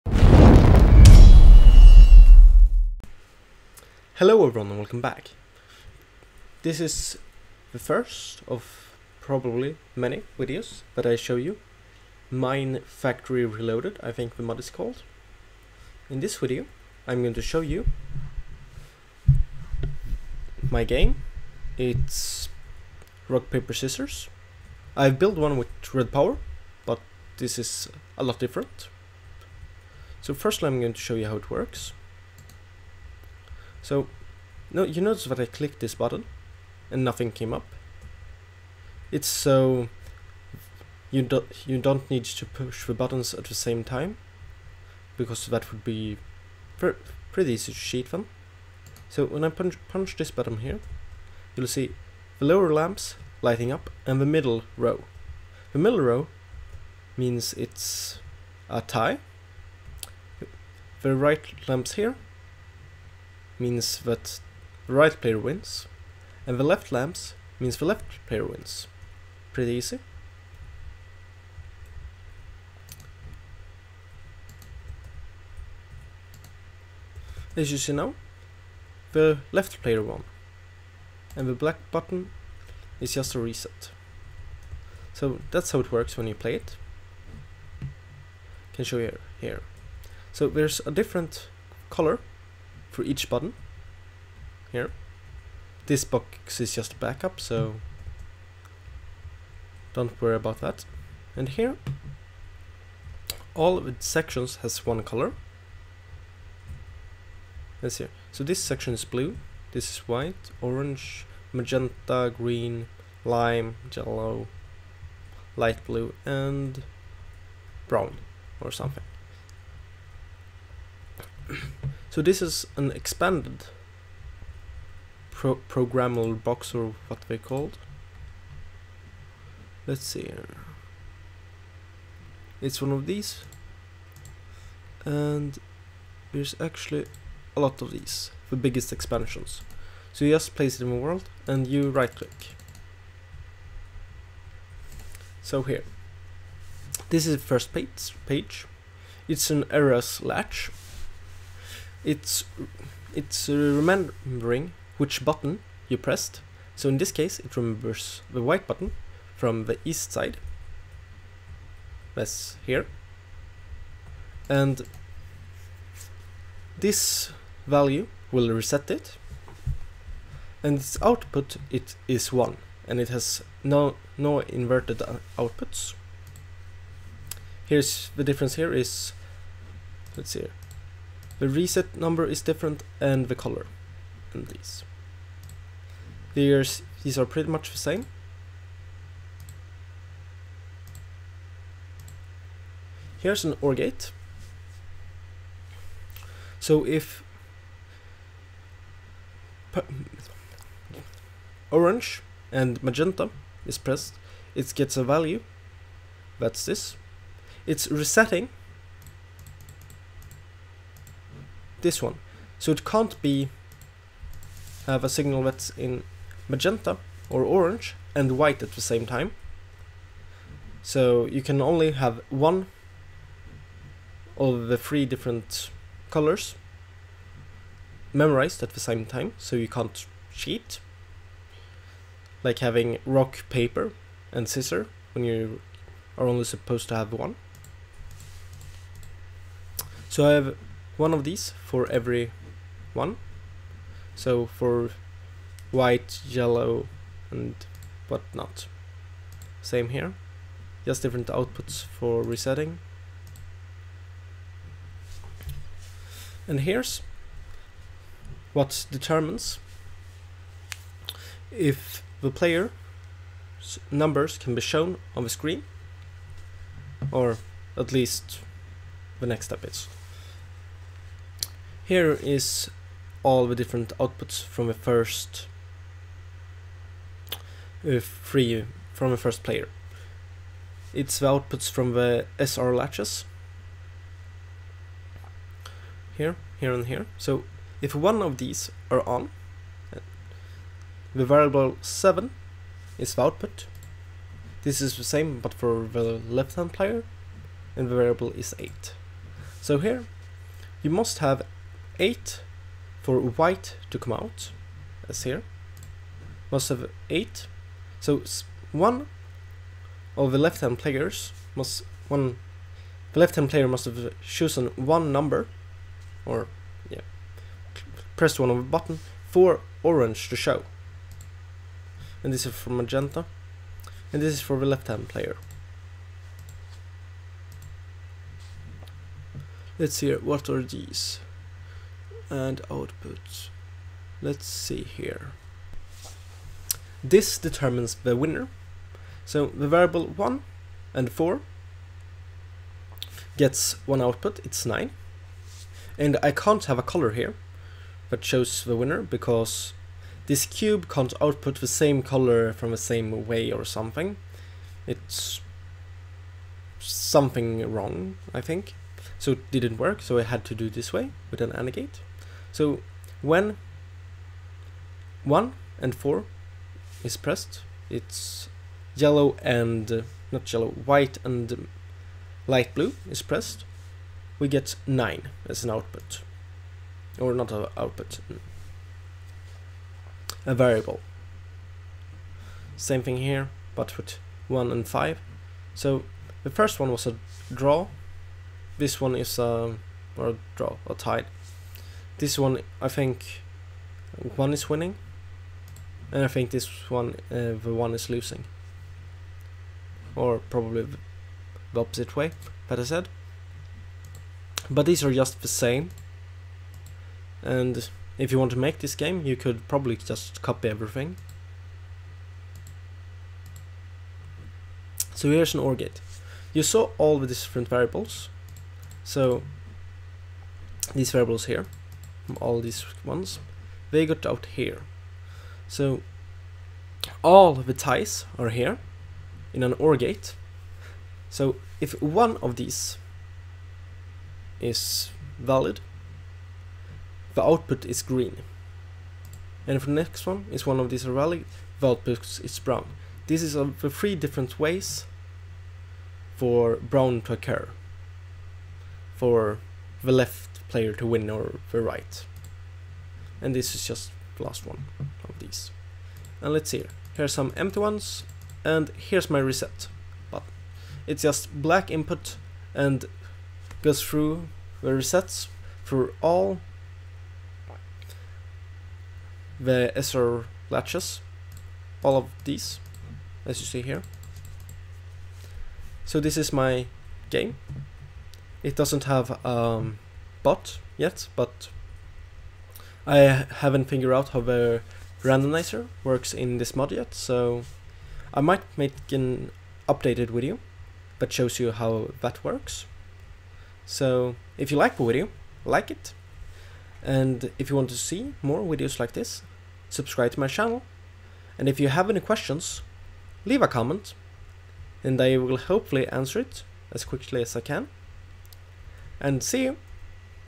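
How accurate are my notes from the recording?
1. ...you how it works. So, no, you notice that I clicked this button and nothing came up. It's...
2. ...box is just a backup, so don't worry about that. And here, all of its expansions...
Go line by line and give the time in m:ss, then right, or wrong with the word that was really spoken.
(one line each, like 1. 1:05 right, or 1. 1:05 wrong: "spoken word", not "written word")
1. 0:31 right
2. 1:36 wrong: "sections", not "expansions".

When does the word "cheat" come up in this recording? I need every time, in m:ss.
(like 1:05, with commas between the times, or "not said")
0:47, 3:50.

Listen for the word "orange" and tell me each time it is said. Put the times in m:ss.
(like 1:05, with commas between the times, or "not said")
1:50, 3:21, 3:37, 5:19.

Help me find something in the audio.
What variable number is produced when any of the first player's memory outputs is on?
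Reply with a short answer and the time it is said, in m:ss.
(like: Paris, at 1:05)
7, at 4:51.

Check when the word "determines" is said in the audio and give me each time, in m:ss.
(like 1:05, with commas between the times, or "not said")
4:18, 5:37.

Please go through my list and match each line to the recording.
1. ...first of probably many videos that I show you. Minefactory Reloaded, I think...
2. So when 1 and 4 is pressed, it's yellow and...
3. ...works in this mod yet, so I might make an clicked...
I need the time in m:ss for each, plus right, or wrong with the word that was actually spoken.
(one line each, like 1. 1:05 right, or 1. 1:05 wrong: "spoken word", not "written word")
1. 0:07 right
2. 6:02 right
3. 8:06 wrong: "updated", not "clicked".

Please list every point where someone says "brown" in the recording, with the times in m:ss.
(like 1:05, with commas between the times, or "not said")
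1:57, 7:22, 7:26.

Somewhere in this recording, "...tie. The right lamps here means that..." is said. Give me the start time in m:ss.
0:58.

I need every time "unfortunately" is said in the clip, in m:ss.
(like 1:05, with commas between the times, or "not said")
not said.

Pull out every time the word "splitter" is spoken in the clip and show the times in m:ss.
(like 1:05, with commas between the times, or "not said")
not said.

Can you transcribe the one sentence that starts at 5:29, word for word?
Let's see what are these and output.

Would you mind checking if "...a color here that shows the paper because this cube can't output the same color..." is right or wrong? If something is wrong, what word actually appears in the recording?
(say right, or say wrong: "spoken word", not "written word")
wrong: "winner", not "paper".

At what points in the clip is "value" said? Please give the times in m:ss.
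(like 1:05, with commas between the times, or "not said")
2:47, 3:25.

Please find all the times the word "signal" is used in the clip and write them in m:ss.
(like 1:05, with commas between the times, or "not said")
3:35.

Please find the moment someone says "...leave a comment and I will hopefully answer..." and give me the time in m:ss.
8:23.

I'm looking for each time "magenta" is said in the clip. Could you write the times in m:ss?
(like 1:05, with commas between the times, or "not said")
1:51, 3:22, 3:36, 5:22.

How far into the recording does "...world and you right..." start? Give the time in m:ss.
2:20.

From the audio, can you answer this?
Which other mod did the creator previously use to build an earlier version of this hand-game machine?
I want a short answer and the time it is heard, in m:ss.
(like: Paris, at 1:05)
RedPower, at 0:25.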